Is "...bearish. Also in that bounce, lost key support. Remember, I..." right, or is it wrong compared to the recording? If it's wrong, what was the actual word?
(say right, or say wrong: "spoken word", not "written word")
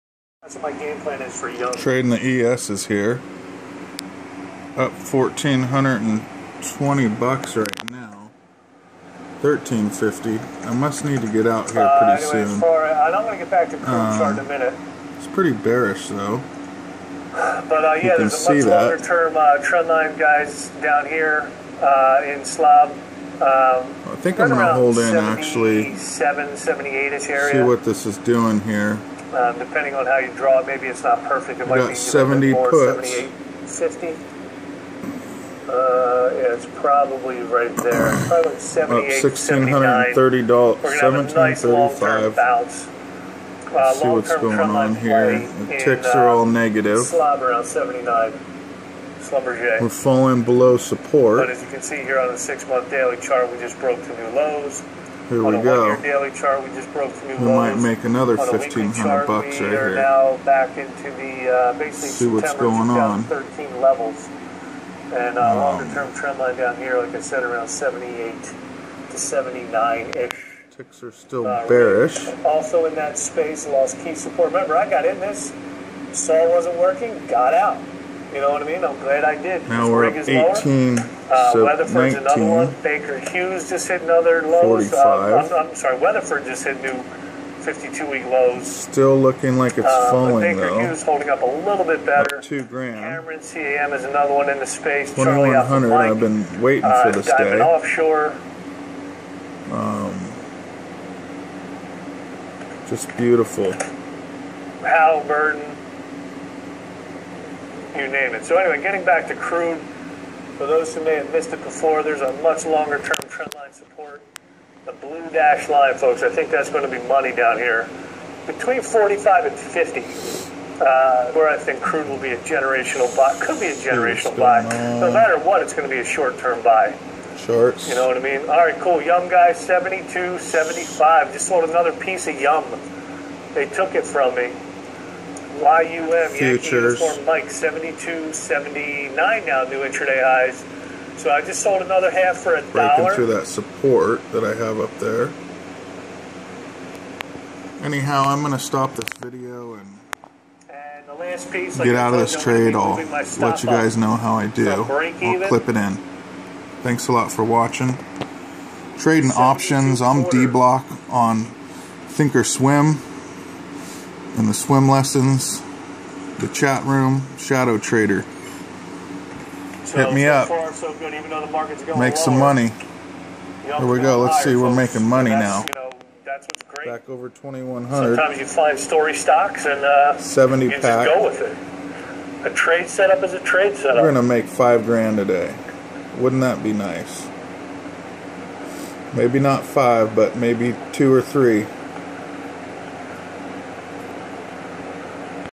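wrong: "space", not "bounce".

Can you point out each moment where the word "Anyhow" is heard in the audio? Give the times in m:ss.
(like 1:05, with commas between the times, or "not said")
2:27.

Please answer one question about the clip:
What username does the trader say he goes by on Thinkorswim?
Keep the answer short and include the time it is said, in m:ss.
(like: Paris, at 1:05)
D Block, at 2:40.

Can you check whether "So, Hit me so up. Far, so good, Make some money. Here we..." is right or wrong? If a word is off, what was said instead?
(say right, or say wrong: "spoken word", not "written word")
right.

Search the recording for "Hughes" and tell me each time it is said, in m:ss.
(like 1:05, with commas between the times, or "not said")
1:23, 1:30.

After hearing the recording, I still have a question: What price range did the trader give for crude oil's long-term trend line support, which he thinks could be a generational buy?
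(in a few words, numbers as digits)
45 to 50.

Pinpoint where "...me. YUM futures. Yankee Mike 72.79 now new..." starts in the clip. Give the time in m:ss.
2:14.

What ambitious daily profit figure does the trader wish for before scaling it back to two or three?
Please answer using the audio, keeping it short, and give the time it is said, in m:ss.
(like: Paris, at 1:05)
$5,000, at 3:04.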